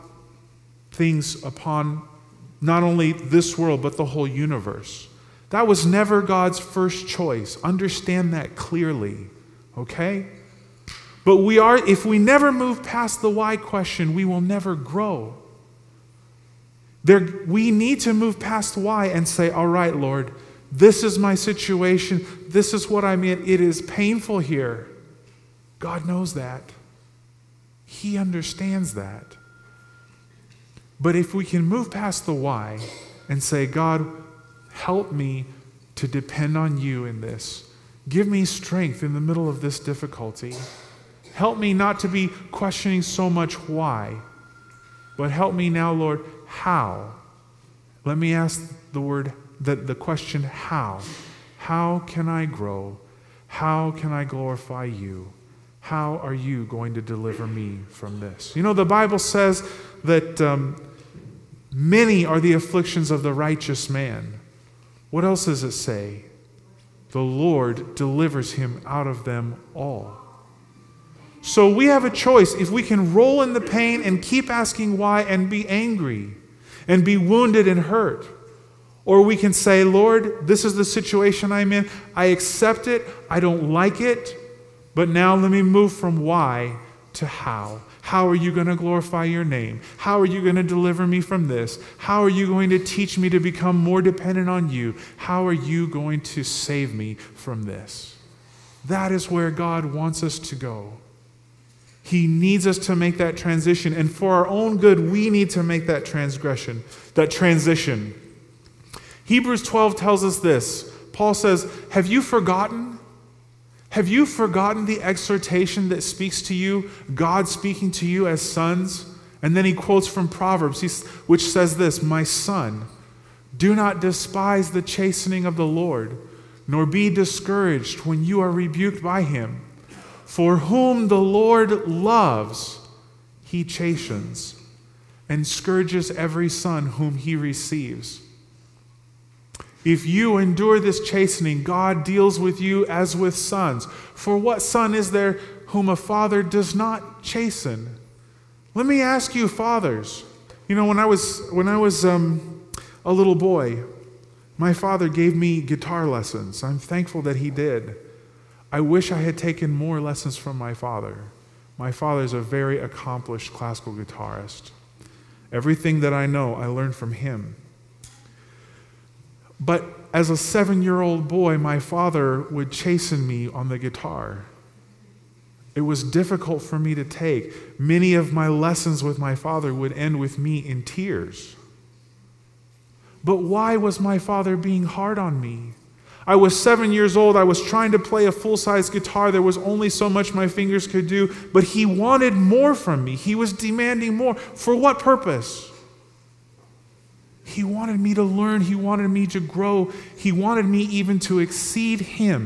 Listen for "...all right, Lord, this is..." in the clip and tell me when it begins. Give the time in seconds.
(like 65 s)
19 s.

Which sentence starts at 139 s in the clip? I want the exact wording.
If you endure this chastening, God deals with you as with sons.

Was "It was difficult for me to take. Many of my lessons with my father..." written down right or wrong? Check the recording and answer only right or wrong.
right.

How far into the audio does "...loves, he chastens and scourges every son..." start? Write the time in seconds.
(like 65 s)
131 s.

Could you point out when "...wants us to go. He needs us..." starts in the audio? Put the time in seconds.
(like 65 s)
99 s.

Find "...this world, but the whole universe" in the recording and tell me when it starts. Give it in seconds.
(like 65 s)
3 s.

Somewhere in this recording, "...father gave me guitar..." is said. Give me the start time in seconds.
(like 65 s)
154 s.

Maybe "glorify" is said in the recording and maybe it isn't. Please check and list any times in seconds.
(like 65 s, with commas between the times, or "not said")
54 s, 88 s.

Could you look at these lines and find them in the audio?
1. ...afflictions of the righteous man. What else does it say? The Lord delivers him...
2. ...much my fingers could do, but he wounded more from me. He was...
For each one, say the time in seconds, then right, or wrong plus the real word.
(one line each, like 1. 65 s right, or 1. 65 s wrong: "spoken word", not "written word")
1. 62 s right
2. 190 s wrong: "wanted", not "wounded".